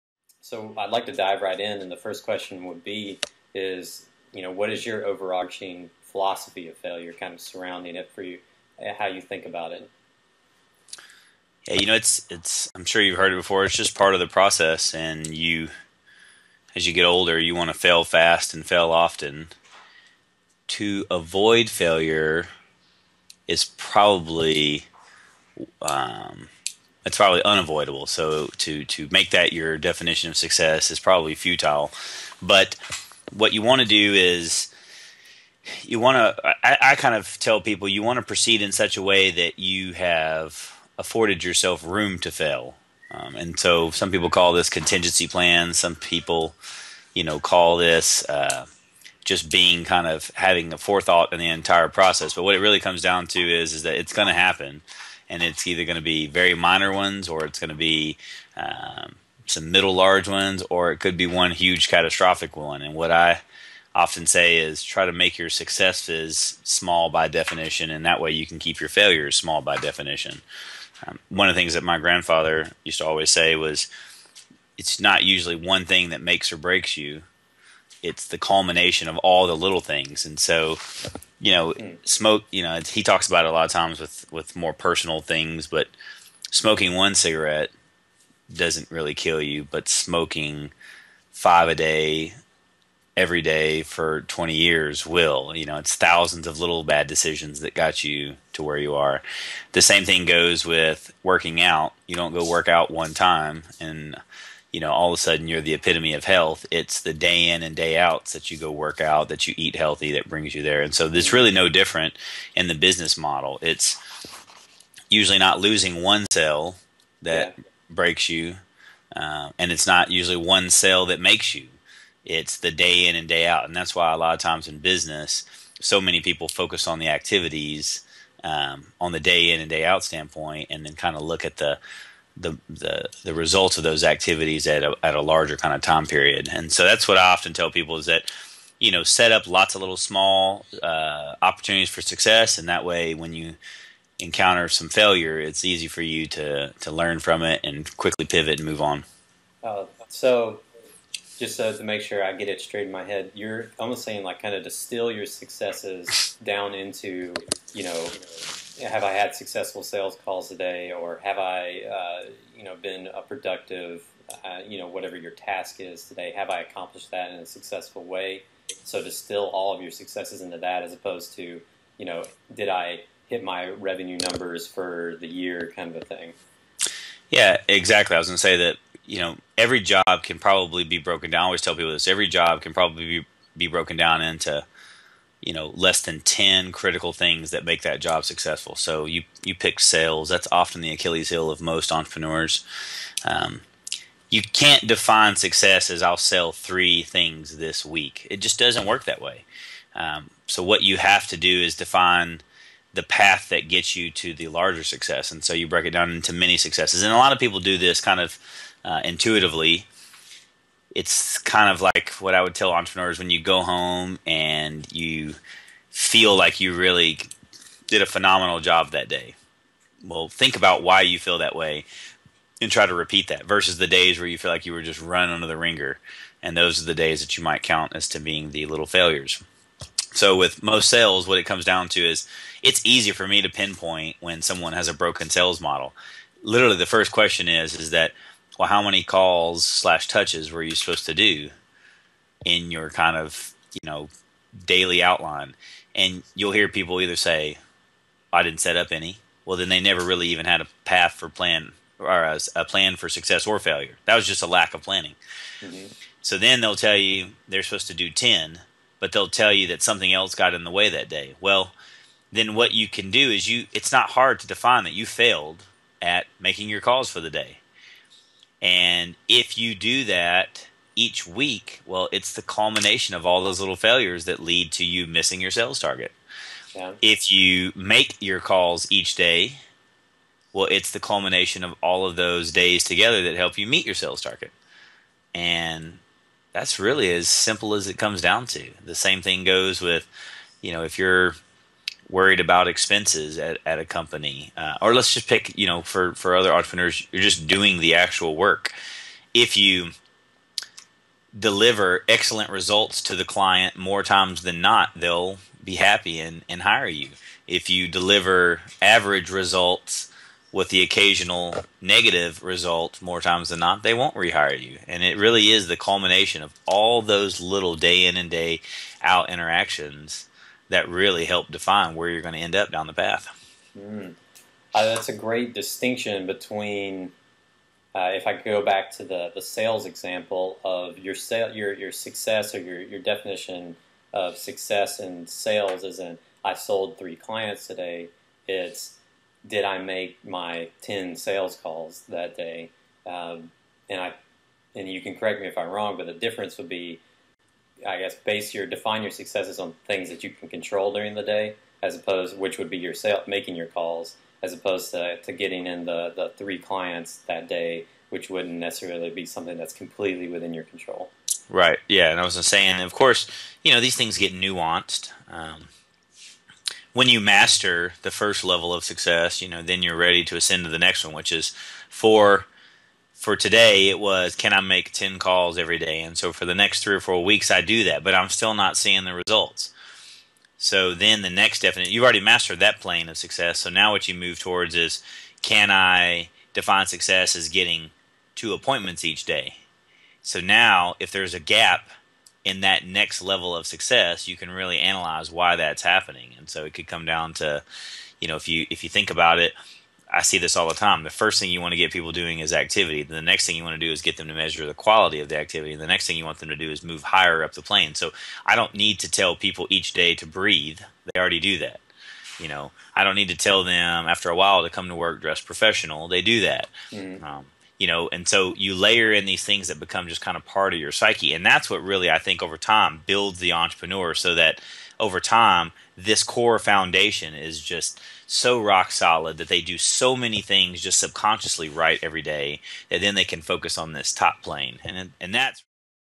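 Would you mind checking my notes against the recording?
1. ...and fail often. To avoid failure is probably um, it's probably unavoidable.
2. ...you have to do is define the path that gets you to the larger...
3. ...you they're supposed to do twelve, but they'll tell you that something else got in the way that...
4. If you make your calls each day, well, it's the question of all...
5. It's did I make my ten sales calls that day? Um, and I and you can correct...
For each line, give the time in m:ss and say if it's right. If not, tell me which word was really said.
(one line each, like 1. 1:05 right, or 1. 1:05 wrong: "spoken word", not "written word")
1. 0:18 right
2. 3:20 right
3. 4:16 wrong: "ten", not "twelve"
4. 4:37 wrong: "culmination", not "question"
5. 5:38 right.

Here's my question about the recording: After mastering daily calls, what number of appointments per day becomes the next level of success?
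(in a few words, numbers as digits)
2.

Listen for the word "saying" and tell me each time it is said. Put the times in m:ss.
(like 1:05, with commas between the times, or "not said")
2:34, 6:02.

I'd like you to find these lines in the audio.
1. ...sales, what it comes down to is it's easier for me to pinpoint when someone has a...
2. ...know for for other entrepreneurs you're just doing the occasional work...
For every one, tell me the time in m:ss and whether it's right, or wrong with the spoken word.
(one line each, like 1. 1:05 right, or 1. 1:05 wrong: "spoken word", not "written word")
1. 3:50 right
2. 4:55 wrong: "actual", not "occasional".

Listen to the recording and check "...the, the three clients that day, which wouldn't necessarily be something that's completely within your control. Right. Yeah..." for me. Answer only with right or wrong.
right.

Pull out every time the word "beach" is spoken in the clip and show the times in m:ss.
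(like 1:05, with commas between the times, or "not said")
not said.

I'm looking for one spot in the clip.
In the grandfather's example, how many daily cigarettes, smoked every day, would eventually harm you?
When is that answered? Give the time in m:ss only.
1:31.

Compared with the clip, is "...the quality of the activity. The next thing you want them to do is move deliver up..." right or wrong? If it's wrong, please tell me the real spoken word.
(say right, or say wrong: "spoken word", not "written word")
wrong: "higher", not "deliver".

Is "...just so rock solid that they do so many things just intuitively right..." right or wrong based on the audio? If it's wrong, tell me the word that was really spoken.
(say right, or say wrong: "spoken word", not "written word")
wrong: "subconsciously", not "intuitively".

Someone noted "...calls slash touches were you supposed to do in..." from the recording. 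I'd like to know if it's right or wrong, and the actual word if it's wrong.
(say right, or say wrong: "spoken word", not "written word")
right.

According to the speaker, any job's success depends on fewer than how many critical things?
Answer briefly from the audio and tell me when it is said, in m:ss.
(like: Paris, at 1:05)
10, at 3:05.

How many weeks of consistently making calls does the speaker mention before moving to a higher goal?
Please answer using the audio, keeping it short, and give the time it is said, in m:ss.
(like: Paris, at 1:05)
3 or 4, at 6:16.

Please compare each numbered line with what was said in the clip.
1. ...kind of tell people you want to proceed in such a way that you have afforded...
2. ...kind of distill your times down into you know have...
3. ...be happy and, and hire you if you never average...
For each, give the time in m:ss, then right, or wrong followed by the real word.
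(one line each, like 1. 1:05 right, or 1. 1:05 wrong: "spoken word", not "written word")
1. 0:36 right
2. 2:34 wrong: "successes", not "times"
3. 5:05 wrong: "deliver", not "never".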